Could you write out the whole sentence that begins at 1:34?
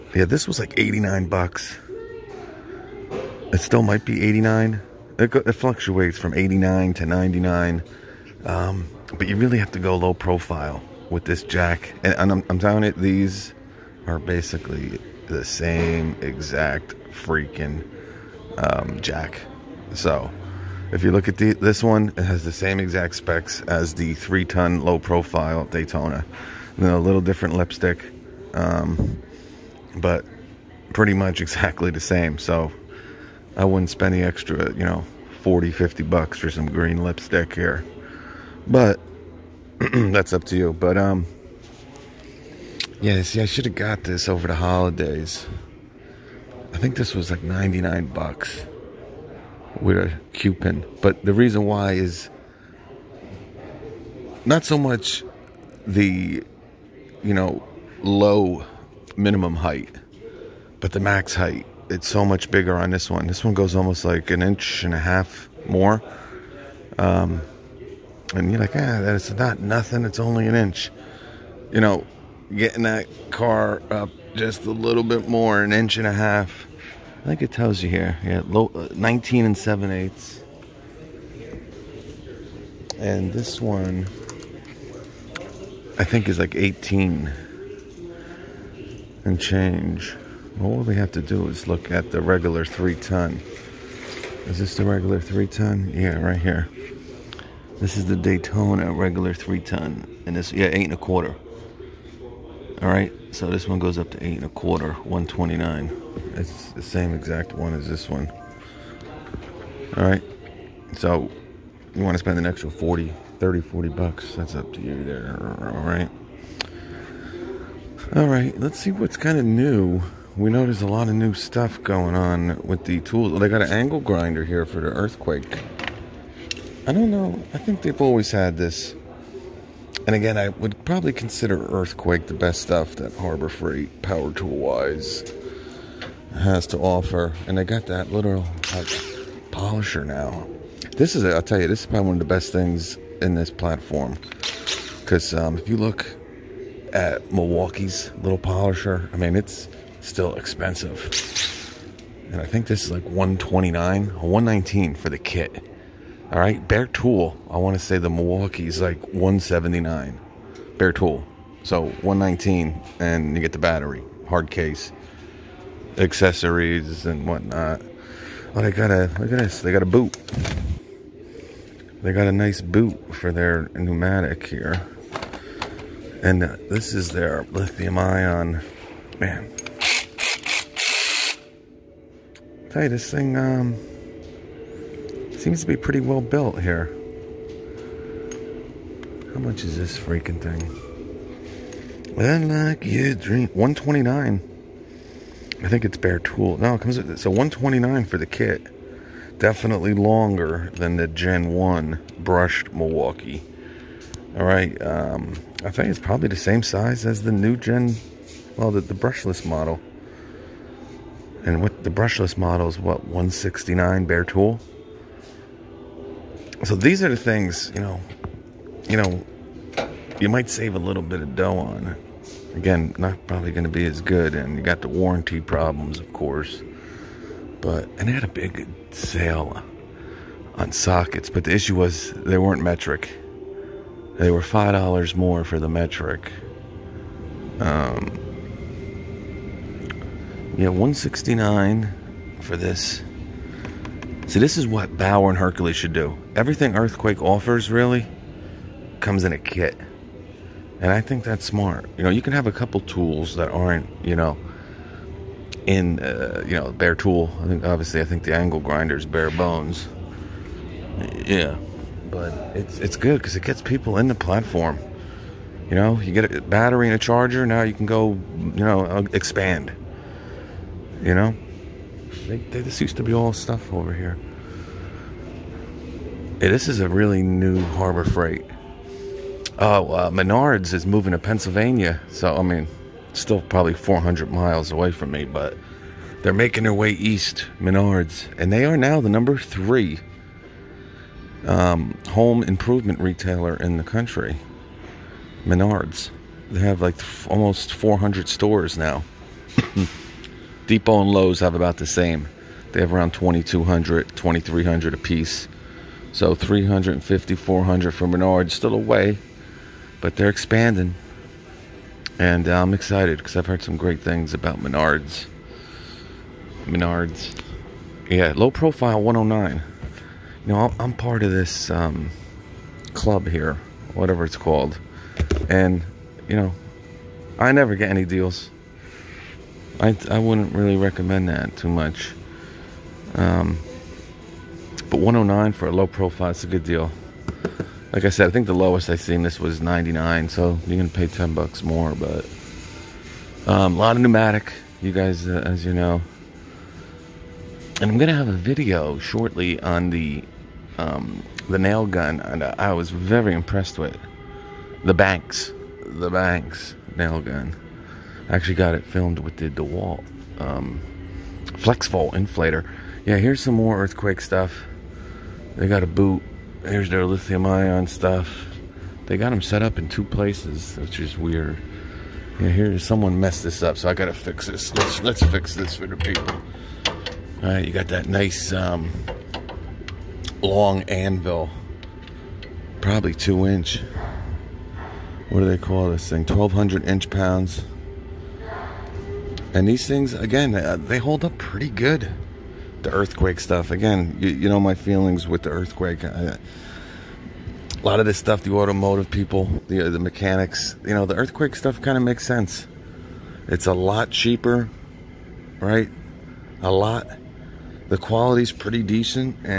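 Is this the regular three ton?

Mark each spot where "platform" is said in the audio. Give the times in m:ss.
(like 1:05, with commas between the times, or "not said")
2:23, 4:24.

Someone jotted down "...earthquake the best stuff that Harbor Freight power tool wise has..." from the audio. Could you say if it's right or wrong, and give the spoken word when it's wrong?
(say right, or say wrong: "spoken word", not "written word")
right.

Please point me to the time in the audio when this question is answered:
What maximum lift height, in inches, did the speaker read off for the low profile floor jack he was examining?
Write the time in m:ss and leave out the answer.
1:18.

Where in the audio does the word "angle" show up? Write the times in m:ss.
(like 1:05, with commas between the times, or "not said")
2:03, 4:18.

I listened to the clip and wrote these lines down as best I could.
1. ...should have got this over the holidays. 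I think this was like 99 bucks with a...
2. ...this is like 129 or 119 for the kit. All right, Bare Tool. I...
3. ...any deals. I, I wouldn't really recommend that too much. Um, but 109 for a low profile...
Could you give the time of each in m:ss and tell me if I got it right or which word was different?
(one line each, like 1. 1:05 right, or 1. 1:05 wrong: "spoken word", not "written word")
1. 0:43 right
2. 2:32 right
3. 5:27 right.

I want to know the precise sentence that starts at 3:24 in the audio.
All right, um, I think it's probably the same size as the new Gen, well, the, the brushless model.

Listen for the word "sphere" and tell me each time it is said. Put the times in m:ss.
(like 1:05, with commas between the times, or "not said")
not said.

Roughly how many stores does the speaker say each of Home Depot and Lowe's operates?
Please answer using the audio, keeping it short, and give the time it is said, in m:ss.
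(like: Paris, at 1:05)
2,200 to 2,300, at 5:03.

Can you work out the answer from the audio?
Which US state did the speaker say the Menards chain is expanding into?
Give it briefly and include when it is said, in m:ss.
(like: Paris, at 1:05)
Pennsylvania, at 4:41.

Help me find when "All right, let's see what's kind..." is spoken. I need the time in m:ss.
1:58.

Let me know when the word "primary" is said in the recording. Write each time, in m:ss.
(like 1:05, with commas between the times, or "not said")
not said.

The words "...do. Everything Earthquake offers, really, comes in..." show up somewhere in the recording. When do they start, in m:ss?
4:05.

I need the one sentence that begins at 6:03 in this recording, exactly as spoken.
Yeah, here's some more earthquake stuff.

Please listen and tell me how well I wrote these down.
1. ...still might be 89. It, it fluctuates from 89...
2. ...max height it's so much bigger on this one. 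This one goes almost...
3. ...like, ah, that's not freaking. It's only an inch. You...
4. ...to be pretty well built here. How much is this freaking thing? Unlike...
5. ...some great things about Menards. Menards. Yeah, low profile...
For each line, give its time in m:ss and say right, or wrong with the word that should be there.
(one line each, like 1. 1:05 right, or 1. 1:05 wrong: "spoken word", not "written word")
1. 0:03 right
2. 1:01 right
3. 1:08 wrong: "nothing", not "freaking"
4. 3:05 right
5. 5:13 right.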